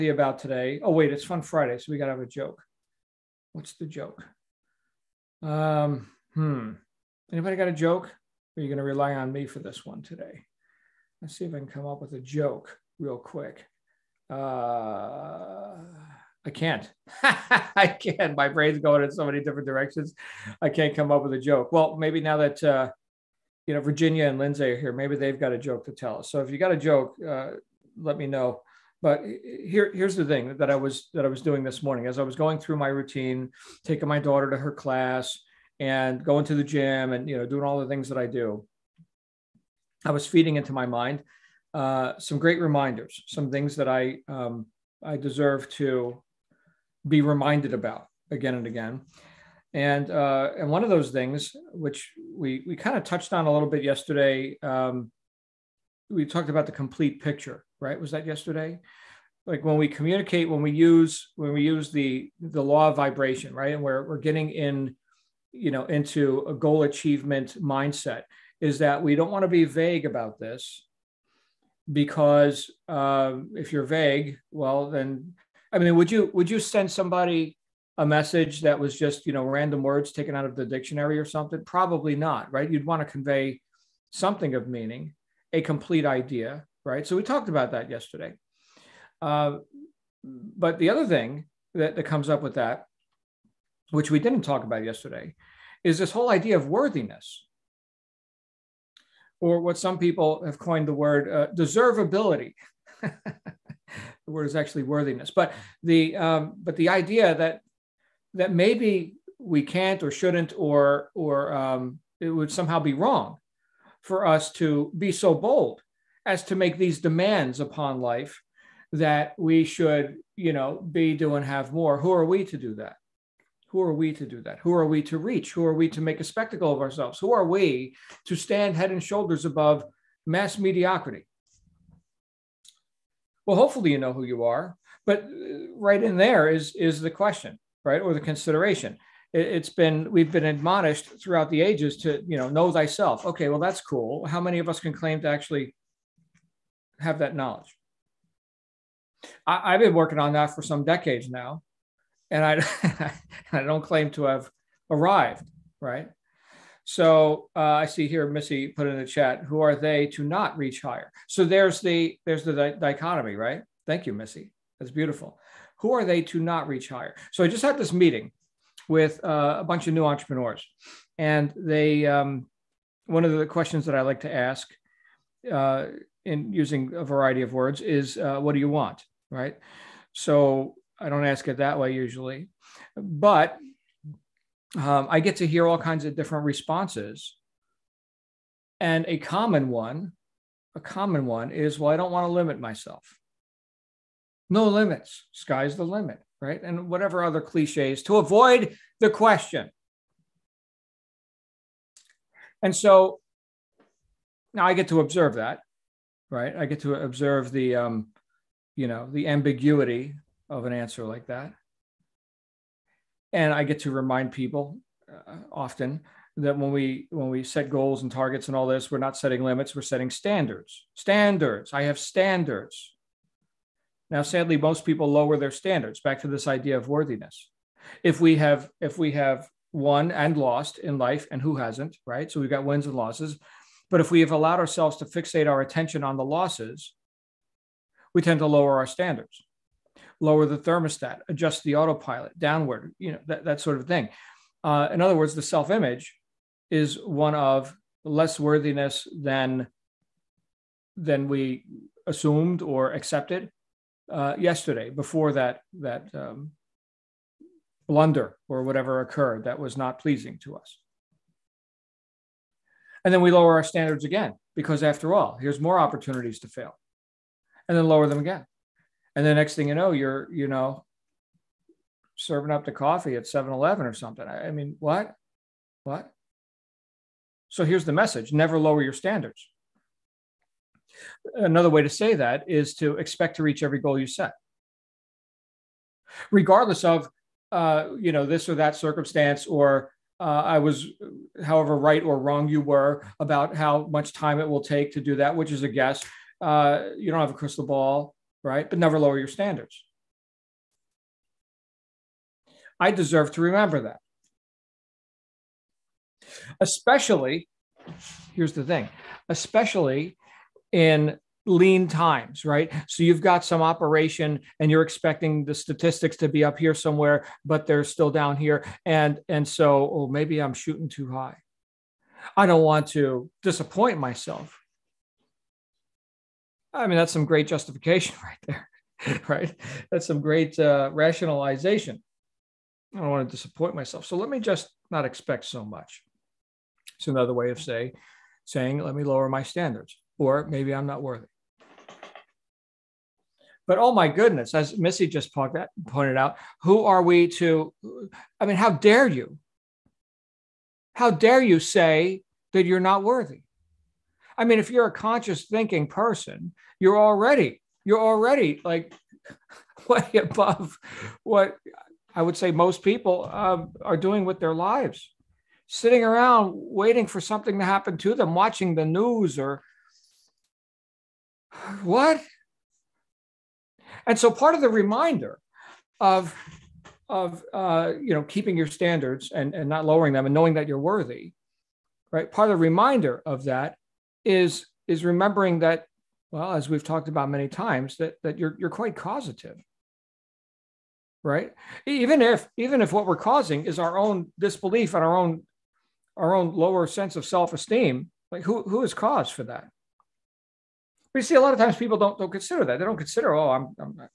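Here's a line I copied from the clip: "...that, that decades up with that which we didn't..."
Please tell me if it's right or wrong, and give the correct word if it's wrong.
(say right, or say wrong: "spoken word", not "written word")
wrong: "comes", not "decades".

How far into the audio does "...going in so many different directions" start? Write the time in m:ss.
0:18.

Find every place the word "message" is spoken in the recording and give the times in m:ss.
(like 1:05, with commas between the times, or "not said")
1:18, 4:37.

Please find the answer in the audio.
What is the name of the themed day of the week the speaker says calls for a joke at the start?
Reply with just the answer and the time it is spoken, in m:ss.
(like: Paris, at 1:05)
Fun Friday, at 0:01.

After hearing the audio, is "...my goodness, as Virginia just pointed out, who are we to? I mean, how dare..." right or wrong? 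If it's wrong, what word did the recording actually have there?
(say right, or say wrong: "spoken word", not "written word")
wrong: "Missy", not "Virginia".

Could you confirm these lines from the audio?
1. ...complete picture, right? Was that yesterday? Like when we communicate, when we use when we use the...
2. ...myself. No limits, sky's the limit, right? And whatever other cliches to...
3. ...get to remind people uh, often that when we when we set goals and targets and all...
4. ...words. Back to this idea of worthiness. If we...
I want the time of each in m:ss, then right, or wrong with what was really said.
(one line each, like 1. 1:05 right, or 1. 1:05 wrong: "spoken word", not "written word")
1. 0:56 right
2. 3:12 right
3. 3:33 right
4. 3:45 wrong: "standards", not "words".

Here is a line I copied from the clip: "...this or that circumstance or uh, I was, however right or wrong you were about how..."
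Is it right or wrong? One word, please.
right.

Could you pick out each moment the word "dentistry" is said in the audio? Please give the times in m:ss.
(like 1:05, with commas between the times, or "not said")
not said.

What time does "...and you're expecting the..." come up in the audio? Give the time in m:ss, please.
5:14.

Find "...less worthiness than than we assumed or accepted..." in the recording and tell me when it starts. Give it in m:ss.
4:08.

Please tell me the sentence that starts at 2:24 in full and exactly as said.
How many of us can claim to actually have that knowledge?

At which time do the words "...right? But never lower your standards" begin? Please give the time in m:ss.
4:58.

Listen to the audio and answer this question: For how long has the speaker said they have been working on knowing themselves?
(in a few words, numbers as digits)
some decades.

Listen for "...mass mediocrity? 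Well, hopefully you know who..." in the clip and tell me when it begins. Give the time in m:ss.
2:10.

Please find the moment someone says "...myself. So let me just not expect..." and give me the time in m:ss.
5:33.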